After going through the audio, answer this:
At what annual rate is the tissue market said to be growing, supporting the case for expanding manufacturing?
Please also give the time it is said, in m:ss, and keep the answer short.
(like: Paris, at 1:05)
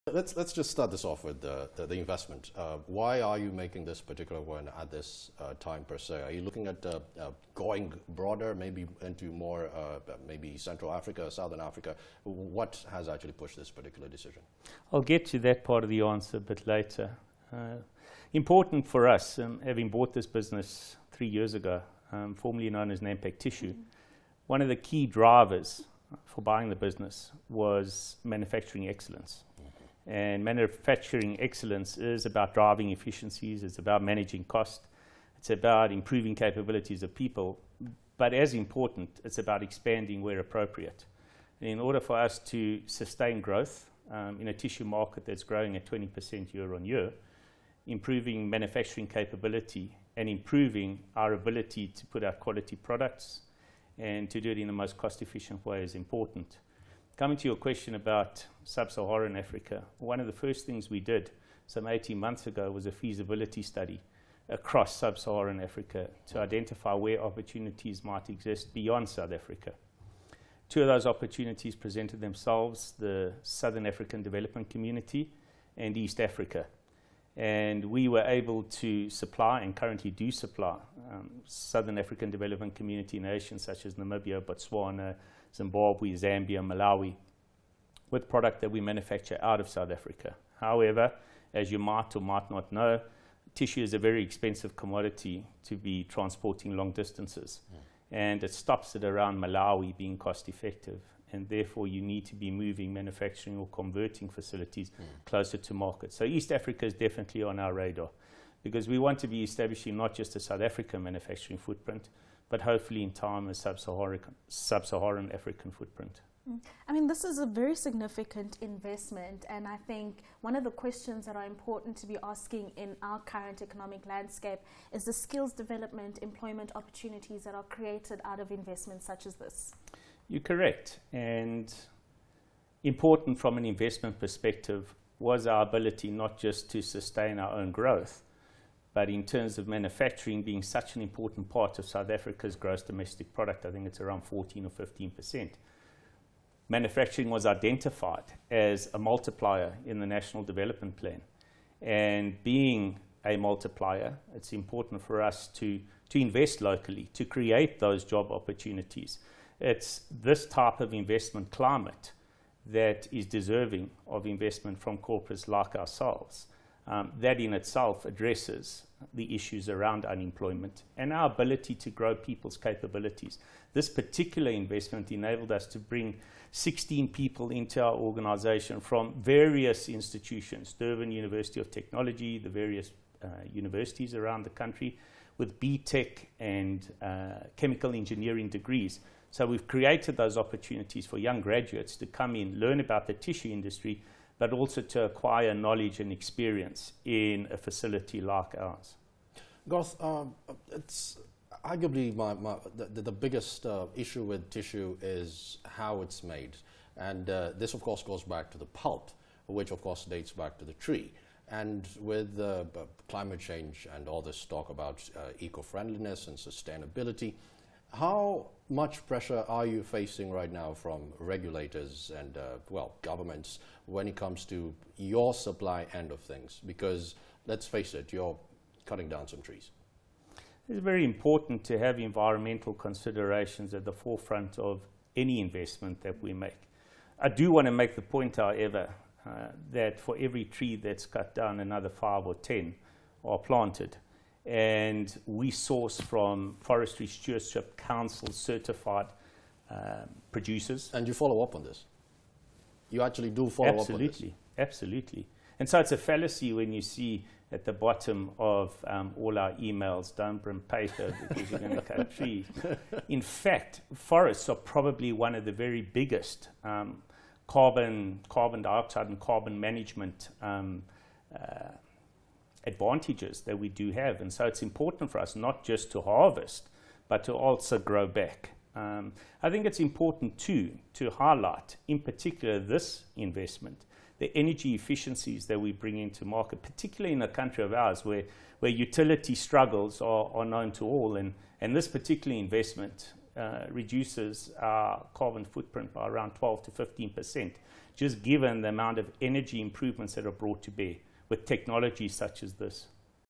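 20%, at 0:45.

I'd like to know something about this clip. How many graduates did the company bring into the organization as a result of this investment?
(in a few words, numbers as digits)
16.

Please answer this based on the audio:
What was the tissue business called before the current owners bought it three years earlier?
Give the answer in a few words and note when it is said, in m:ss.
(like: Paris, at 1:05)
Nampak Tissue, at 0:23.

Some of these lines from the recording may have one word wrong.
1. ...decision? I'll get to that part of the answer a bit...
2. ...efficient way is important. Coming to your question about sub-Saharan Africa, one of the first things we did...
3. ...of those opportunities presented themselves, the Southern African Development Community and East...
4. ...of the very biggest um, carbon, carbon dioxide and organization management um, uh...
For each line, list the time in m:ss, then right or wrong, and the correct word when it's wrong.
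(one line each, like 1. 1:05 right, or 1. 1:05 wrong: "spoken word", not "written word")
1. 0:14 right
2. 0:55 right
3. 1:10 right
4. 4:25 wrong: "carbon", not "organization".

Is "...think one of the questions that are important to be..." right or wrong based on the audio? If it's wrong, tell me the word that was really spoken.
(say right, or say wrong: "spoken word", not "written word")
right.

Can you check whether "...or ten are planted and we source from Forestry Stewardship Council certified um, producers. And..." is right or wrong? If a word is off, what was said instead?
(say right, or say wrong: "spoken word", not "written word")
right.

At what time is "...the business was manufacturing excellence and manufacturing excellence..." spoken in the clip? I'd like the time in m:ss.
0:26.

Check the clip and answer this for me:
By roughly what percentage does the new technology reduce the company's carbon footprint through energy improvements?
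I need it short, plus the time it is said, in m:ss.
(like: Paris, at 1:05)
12 to 15 percent, at 4:56.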